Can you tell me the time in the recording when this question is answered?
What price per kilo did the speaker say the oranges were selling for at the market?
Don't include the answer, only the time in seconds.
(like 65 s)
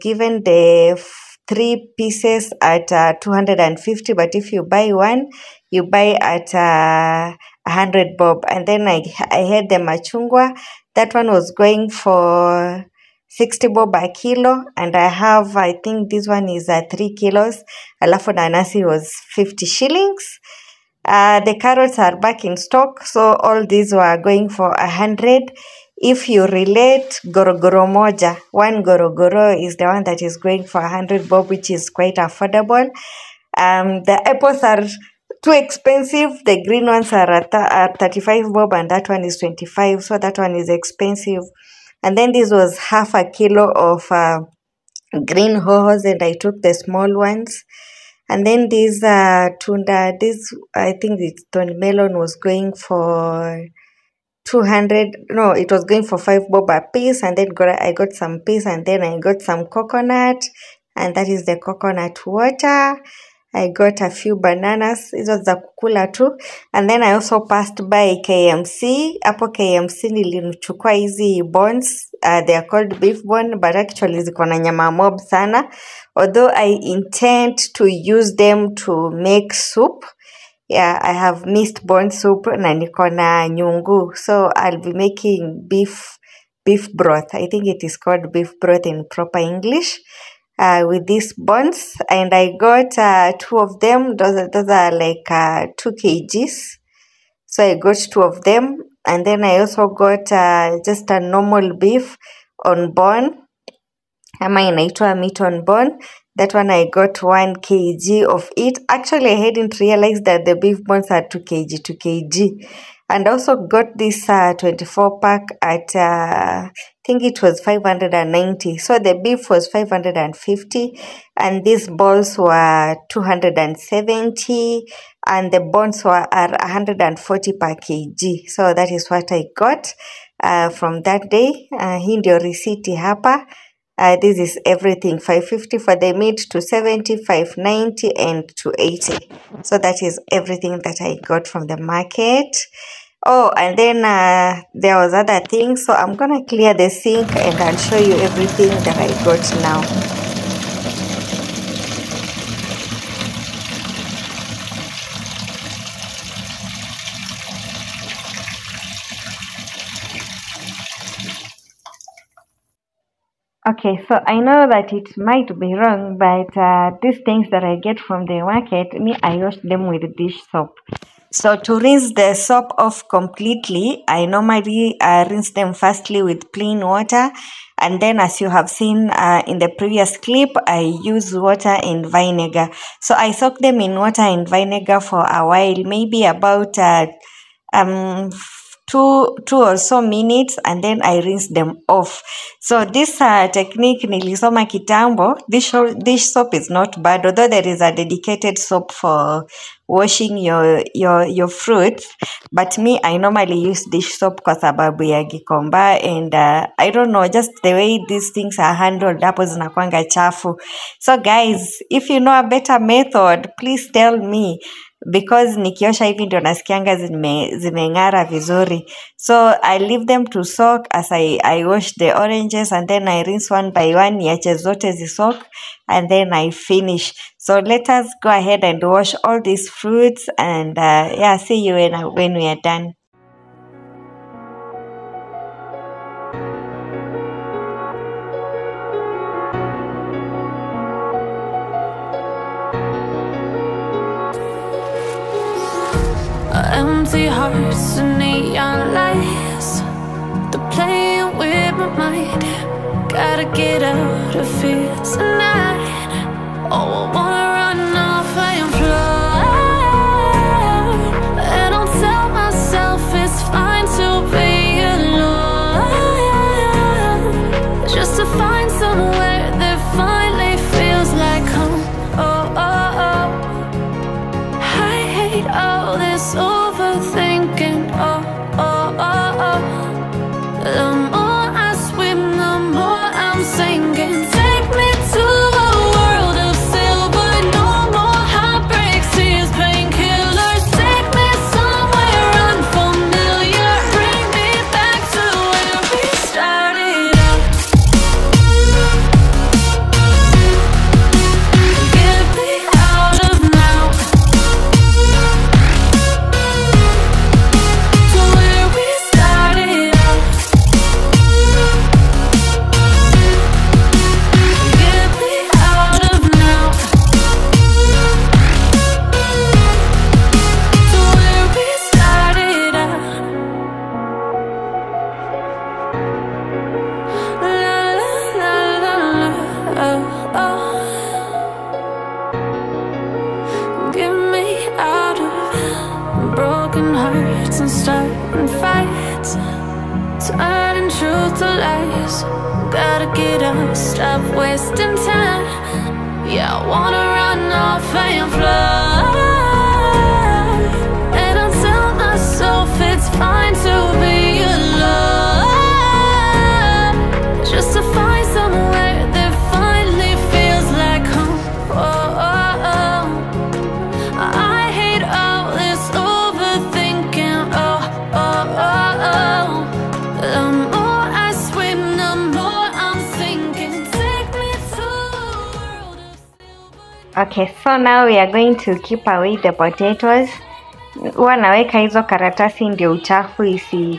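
13 s.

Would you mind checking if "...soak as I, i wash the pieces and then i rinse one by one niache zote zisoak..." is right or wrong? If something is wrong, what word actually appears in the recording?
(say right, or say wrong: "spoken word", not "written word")
wrong: "oranges", not "pieces".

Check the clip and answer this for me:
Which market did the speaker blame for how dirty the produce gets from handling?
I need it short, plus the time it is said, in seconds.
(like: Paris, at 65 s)
Gikomba, at 205 s.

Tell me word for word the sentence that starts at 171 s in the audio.
So to rinse the soap off completely, I normally uh, rinse them firstly with plain water.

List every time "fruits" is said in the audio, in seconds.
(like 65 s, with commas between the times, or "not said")
201 s, 229 s.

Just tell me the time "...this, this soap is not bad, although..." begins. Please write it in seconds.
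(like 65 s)
195 s.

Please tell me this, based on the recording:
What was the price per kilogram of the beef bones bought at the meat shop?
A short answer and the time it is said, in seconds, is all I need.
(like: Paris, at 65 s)
140, at 126 s.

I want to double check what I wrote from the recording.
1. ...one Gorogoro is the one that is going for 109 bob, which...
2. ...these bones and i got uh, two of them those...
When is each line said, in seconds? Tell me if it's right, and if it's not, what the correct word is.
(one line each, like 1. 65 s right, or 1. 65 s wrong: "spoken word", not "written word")
1. 28 s wrong: "100", not "109"
2. 91 s right.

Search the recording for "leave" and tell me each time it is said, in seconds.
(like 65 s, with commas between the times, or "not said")
219 s.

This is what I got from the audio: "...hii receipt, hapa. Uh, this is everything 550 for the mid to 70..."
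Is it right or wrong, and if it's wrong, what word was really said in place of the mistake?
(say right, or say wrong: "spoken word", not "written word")
right.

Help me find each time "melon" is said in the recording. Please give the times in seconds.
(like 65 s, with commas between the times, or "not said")
51 s.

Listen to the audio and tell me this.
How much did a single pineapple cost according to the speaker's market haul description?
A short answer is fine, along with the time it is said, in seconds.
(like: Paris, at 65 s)
50 shillings, at 19 s.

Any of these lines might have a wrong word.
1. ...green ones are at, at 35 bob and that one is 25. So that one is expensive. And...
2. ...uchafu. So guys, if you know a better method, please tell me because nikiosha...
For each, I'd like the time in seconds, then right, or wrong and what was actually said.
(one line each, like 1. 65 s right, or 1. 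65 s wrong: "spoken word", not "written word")
1. 36 s right
2. 210 s wrong: "chafu", not "uchafu".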